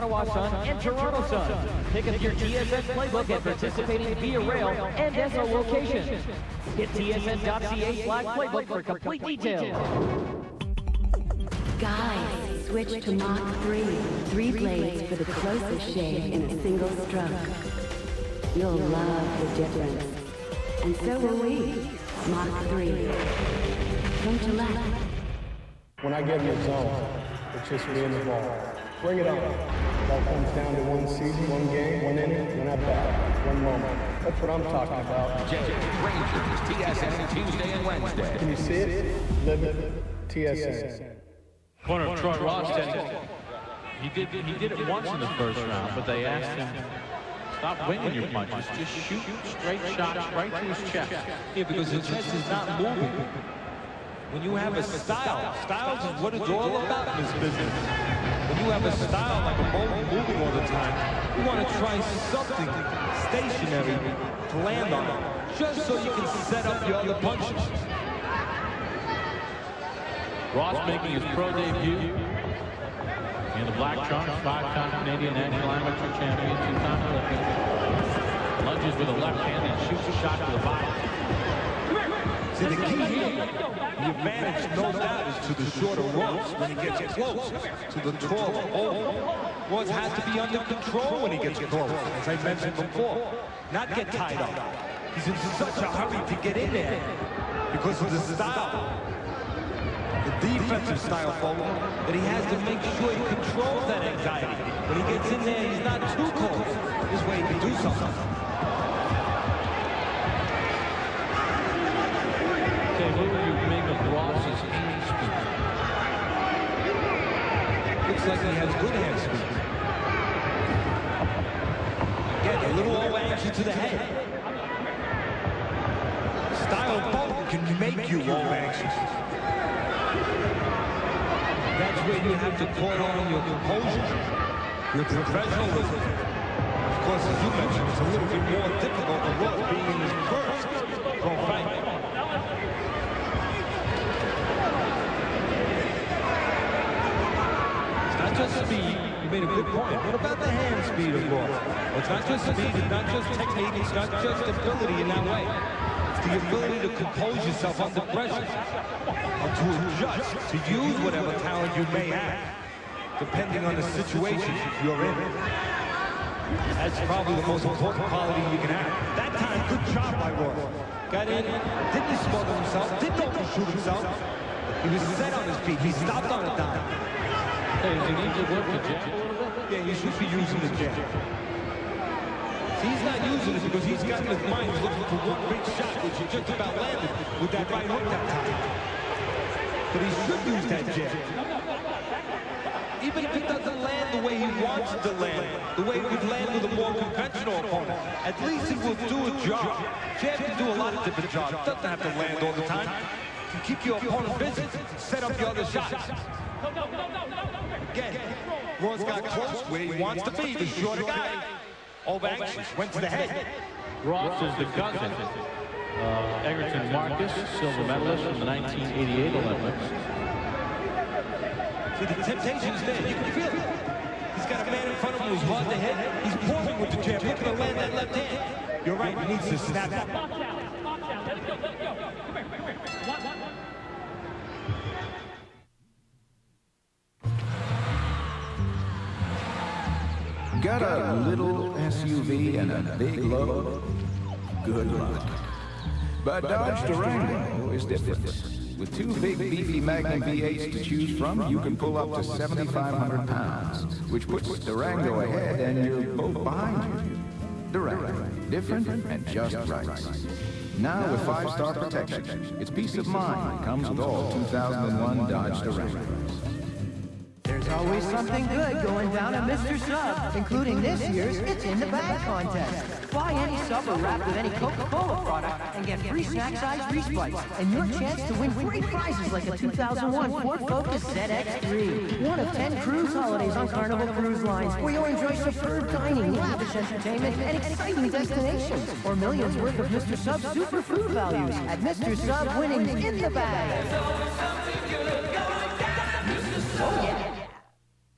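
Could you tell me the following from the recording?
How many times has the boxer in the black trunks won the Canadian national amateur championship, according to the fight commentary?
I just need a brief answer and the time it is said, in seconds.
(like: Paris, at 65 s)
5, at 74 s.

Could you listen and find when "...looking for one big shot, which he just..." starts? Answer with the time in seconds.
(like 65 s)
184 s.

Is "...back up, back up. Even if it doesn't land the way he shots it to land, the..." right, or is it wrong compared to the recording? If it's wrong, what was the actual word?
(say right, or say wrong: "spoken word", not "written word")
wrong: "wants", not "shots".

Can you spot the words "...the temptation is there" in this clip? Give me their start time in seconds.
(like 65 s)
222 s.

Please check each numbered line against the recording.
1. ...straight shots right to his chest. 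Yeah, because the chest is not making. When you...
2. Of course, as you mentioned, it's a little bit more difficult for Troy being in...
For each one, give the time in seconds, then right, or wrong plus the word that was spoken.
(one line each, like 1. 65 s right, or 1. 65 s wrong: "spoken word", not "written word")
1. 49 s wrong: "moving", not "making"
2. 136 s wrong: "Ross", not "Troy".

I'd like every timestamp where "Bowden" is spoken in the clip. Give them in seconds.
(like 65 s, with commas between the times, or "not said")
88 s, 101 s, 127 s.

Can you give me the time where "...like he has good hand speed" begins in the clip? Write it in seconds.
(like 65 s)
118 s.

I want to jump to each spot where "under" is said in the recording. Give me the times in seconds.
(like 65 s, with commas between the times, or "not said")
90 s, 157 s.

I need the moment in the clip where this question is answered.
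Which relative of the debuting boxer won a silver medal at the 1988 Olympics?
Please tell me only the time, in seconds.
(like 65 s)
216 s.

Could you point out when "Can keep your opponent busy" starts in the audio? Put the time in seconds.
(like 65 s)
203 s.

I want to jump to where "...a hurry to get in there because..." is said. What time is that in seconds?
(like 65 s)
95 s.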